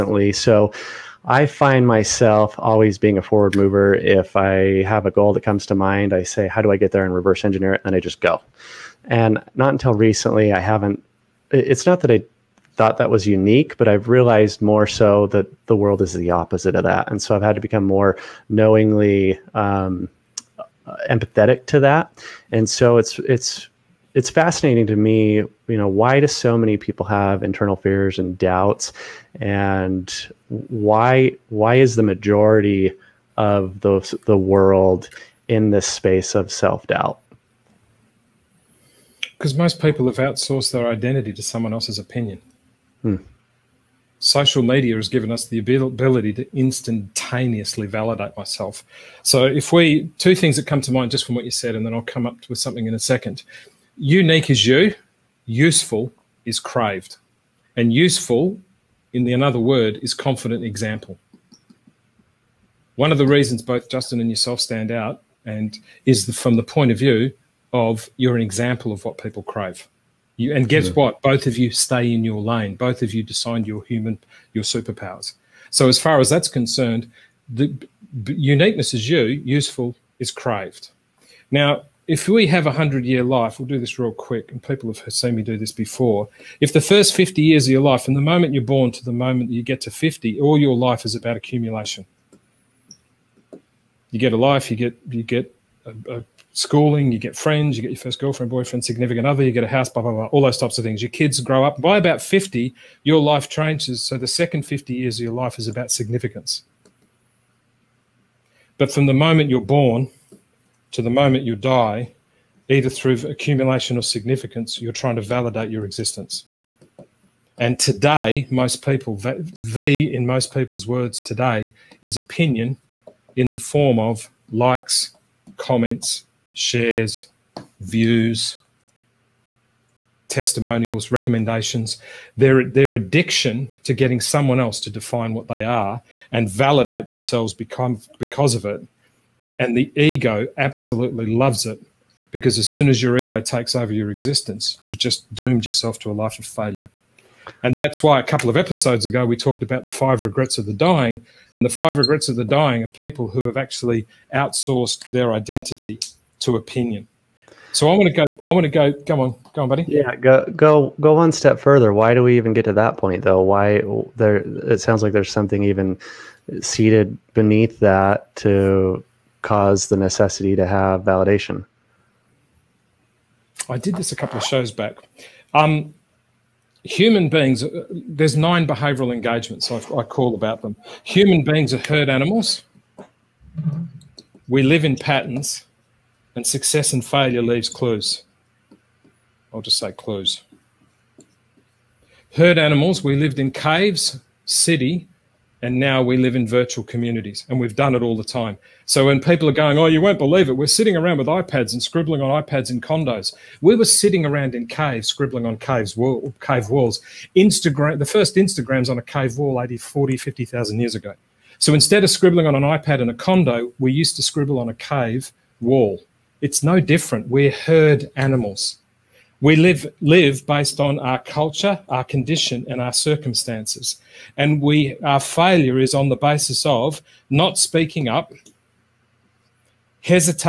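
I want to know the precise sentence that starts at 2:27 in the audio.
And that's why a couple of episodes ago we talked about the five regrets of the dying.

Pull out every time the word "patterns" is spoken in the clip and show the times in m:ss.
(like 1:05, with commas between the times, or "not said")
3:04.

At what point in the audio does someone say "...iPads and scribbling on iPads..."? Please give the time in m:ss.
3:21.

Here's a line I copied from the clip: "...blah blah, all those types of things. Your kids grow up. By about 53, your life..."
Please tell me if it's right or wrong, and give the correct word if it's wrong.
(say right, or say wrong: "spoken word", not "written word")
wrong: "50", not "53".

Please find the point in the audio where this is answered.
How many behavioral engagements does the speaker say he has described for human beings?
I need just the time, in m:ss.
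2:58.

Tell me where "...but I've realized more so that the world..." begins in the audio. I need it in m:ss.
0:13.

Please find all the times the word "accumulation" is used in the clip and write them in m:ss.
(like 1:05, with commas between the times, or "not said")
1:31, 1:53.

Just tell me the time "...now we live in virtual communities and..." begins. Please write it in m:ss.
3:15.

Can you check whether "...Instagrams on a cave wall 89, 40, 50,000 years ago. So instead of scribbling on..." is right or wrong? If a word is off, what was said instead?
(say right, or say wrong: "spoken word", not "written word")
wrong: "80", not "89".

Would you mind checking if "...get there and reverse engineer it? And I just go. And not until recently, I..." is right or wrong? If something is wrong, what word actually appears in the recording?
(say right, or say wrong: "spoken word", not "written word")
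right.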